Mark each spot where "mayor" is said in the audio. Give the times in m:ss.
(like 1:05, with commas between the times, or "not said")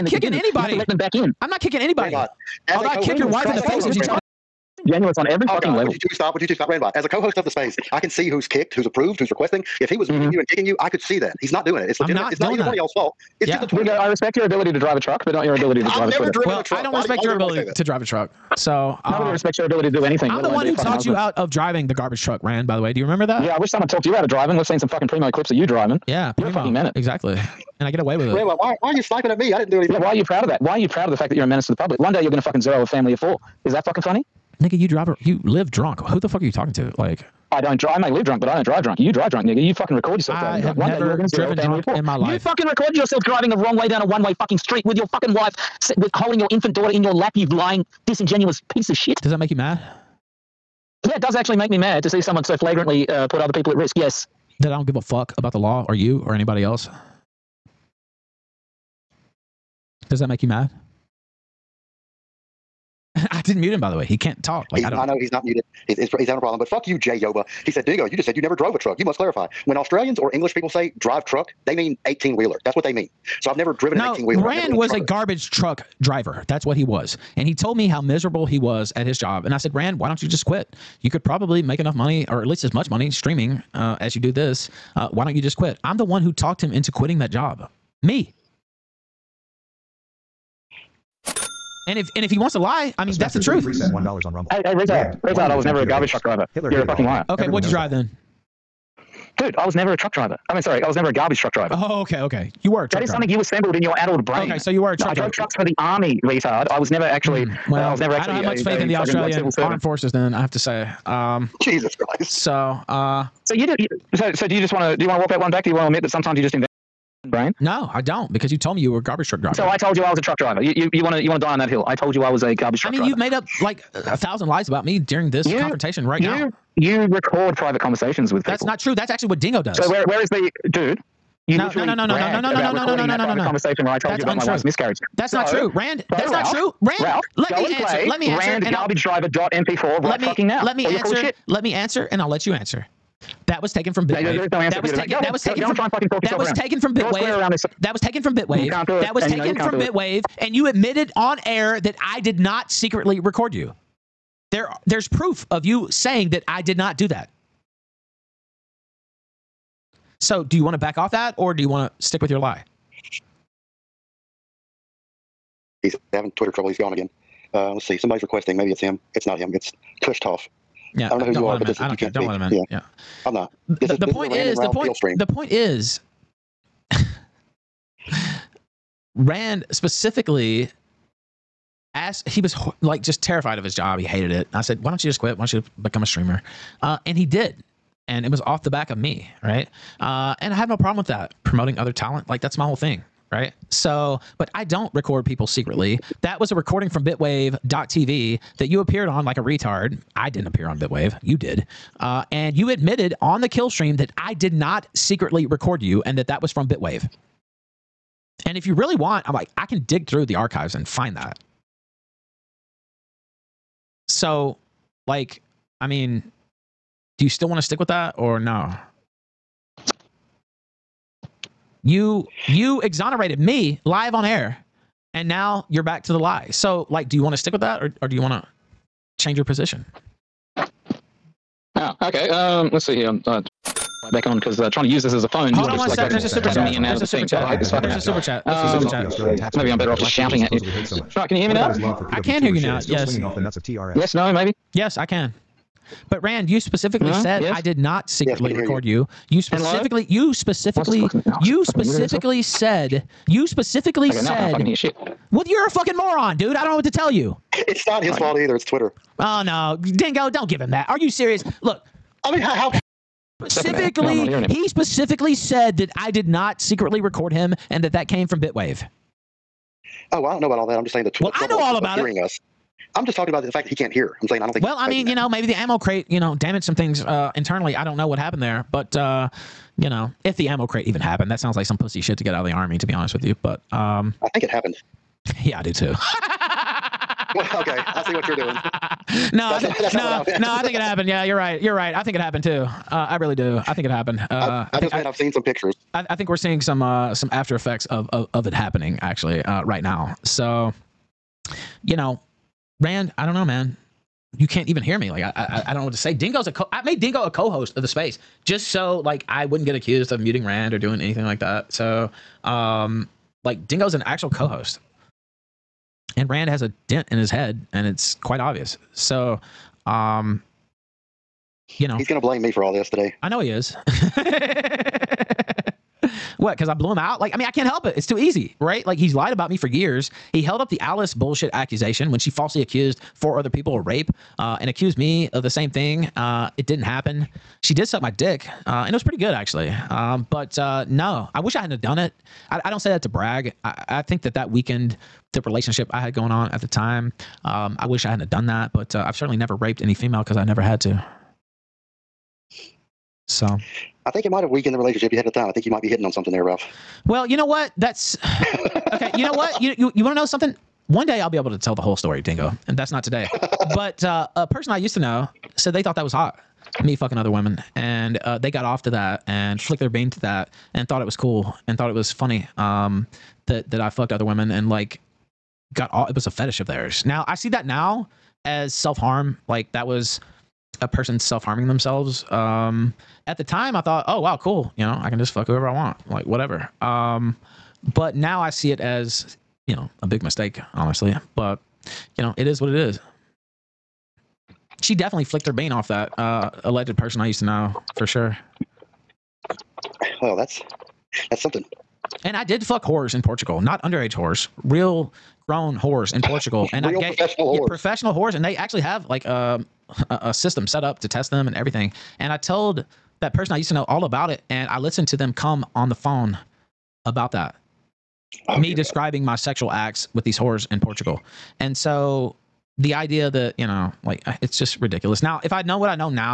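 not said.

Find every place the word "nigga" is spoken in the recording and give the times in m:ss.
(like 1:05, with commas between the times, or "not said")
0:34, 0:39.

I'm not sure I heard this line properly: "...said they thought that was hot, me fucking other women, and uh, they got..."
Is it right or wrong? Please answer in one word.
right.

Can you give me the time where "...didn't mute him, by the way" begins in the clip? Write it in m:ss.
1:03.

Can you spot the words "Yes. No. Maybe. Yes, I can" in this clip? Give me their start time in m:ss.
4:03.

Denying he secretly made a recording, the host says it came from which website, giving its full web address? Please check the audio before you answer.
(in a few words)
bitwave.tv.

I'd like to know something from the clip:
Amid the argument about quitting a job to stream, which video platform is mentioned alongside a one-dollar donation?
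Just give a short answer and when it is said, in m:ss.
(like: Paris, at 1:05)
Rumble, at 1:34.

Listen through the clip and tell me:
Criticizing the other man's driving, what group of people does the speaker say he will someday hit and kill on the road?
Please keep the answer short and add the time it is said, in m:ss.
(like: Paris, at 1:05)
a family of four, at 0:32.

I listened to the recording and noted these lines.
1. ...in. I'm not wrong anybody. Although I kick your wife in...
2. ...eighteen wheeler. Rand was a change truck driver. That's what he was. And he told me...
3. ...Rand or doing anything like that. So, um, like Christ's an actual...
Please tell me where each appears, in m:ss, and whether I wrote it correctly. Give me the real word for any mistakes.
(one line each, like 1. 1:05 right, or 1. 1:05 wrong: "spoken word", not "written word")
1. 0:01 wrong: "kicking", not "wrong"
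2. 1:14 wrong: "garbage", not "change"
3. 5:10 wrong: "Dingo", not "Christ".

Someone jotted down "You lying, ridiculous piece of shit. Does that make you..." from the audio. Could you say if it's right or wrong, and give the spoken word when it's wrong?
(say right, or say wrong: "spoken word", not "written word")
wrong: "disingenuous", not "ridiculous".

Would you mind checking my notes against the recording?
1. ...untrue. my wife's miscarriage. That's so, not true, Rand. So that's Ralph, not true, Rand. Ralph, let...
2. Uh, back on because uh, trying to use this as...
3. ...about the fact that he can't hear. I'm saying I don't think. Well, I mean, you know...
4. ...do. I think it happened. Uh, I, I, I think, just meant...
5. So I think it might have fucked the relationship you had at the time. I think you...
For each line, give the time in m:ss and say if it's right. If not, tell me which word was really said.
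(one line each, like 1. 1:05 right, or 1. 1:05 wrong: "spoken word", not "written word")
1. 2:14 right
2. 3:53 right
3. 4:33 right
4. 4:53 right
5. 5:53 wrong: "weakened", not "fucked".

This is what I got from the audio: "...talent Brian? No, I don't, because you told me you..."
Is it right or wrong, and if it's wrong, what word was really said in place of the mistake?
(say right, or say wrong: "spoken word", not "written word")
wrong: "invent", not "talent".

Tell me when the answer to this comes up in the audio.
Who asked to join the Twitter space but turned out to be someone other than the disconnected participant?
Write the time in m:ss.
2:50.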